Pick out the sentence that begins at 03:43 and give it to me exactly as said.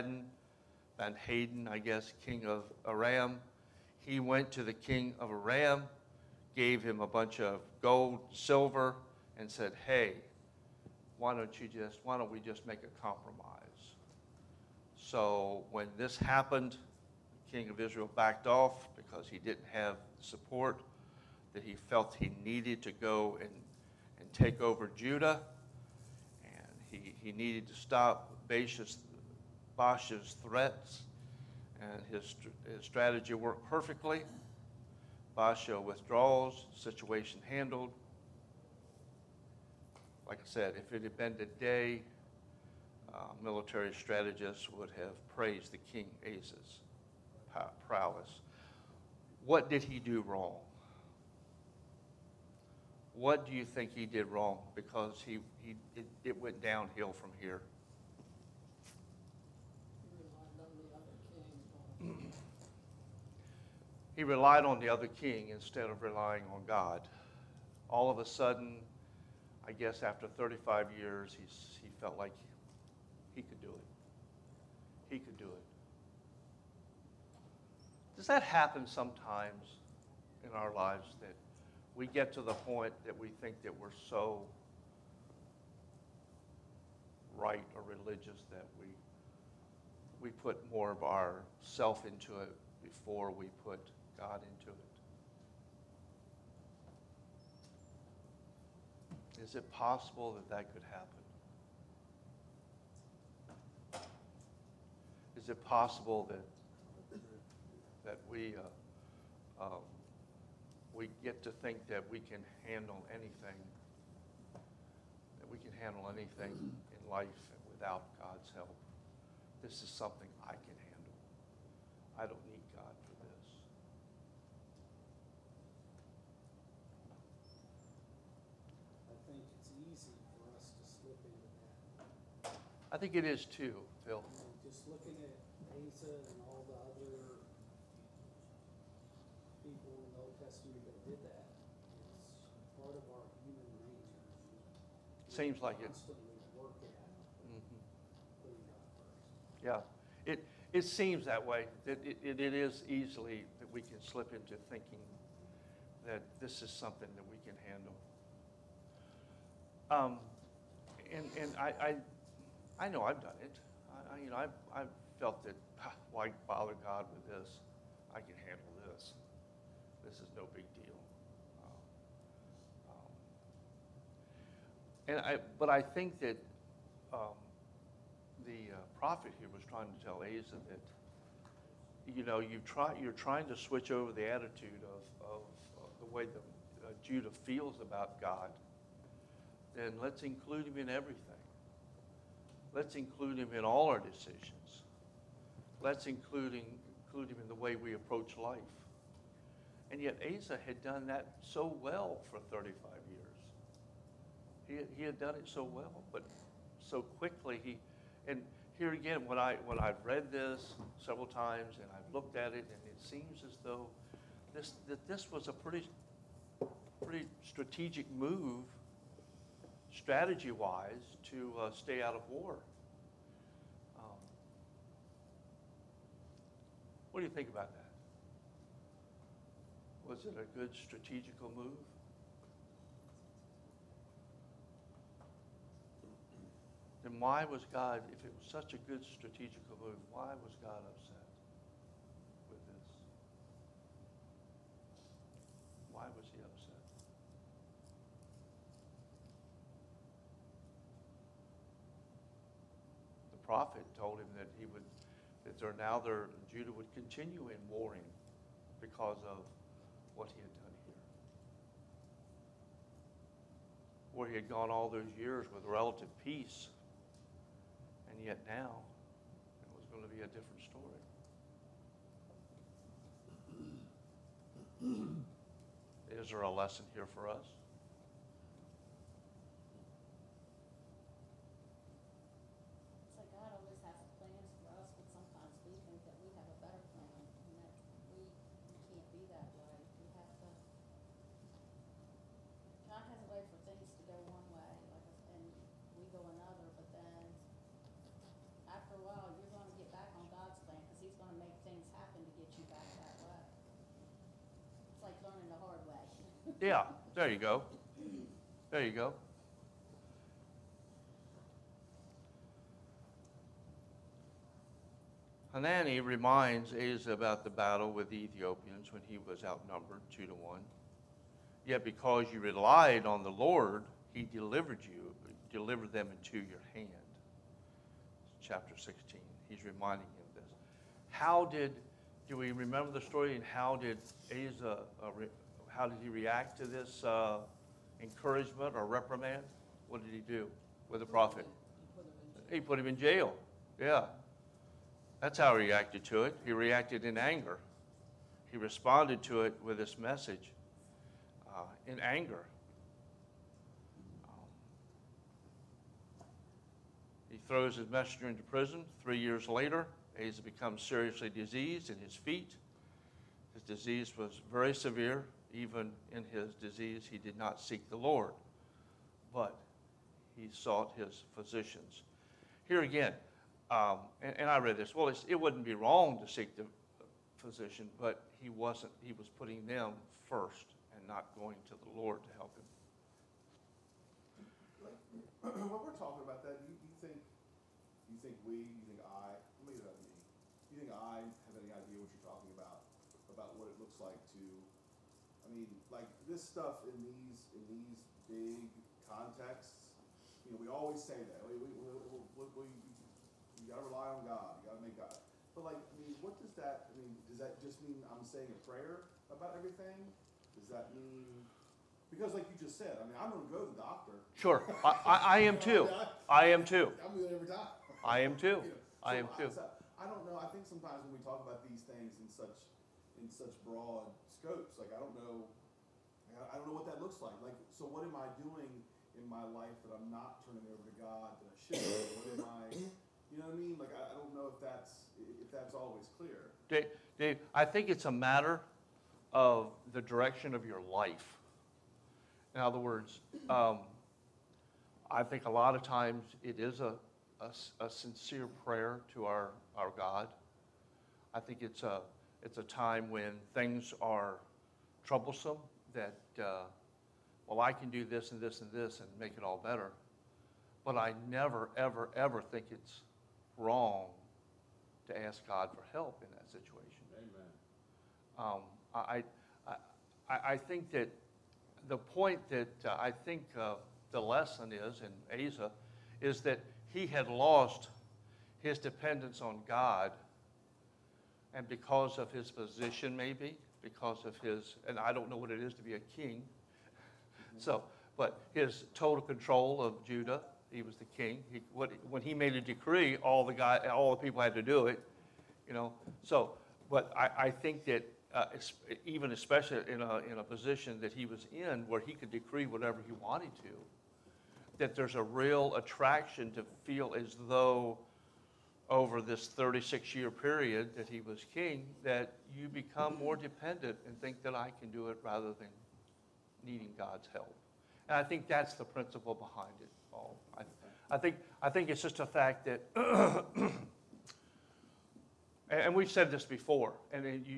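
Um, what do you think about that?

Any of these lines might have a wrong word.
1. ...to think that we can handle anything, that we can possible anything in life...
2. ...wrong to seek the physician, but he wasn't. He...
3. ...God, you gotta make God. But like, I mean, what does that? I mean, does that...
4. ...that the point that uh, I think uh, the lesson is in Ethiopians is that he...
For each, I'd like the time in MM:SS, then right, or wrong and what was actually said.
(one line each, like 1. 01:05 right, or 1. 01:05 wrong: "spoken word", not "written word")
1. 01:51 wrong: "handle", not "possible"
2. 06:15 right
3. 06:44 right
4. 07:50 wrong: "Asa", not "Ethiopians".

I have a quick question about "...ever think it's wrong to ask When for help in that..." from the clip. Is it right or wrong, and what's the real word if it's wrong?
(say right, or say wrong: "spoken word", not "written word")
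wrong: "God", not "When".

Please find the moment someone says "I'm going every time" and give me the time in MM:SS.
06:57.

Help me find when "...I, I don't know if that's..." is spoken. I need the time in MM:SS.
07:13.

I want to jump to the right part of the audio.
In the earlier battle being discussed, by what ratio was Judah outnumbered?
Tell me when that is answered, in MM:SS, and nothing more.
05:20.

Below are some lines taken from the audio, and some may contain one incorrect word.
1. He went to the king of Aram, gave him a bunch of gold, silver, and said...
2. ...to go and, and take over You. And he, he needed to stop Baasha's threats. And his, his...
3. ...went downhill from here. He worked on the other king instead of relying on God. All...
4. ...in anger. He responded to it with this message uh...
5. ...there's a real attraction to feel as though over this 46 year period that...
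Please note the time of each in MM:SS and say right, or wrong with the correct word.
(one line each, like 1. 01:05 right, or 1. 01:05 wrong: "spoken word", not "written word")
1. 00:04 right
2. 00:22 wrong: "Judah", not "You"
3. 00:56 wrong: "relied", not "worked"
4. 05:47 right
5. 08:24 wrong: "36", not "46".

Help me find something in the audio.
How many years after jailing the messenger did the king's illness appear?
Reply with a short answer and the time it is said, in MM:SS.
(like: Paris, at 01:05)
3 years, at 05:59.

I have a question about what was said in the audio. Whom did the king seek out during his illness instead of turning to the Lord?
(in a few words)
His physicians.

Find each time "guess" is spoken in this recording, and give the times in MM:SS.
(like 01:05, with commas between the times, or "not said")
00:01, 01:09.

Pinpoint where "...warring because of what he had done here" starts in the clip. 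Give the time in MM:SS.
04:17.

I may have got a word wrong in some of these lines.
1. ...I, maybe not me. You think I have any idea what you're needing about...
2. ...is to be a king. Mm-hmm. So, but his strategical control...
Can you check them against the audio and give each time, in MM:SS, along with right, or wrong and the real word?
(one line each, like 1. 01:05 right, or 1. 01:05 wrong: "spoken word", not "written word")
1. 06:29 wrong: "talking", not "needing"
2. 08:05 wrong: "total", not "strategical".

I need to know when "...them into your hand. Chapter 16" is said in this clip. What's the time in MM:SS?
05:25.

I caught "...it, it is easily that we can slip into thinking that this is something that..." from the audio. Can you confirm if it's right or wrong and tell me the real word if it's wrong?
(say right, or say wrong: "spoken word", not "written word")
right.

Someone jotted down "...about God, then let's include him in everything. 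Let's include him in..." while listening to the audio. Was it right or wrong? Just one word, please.
right.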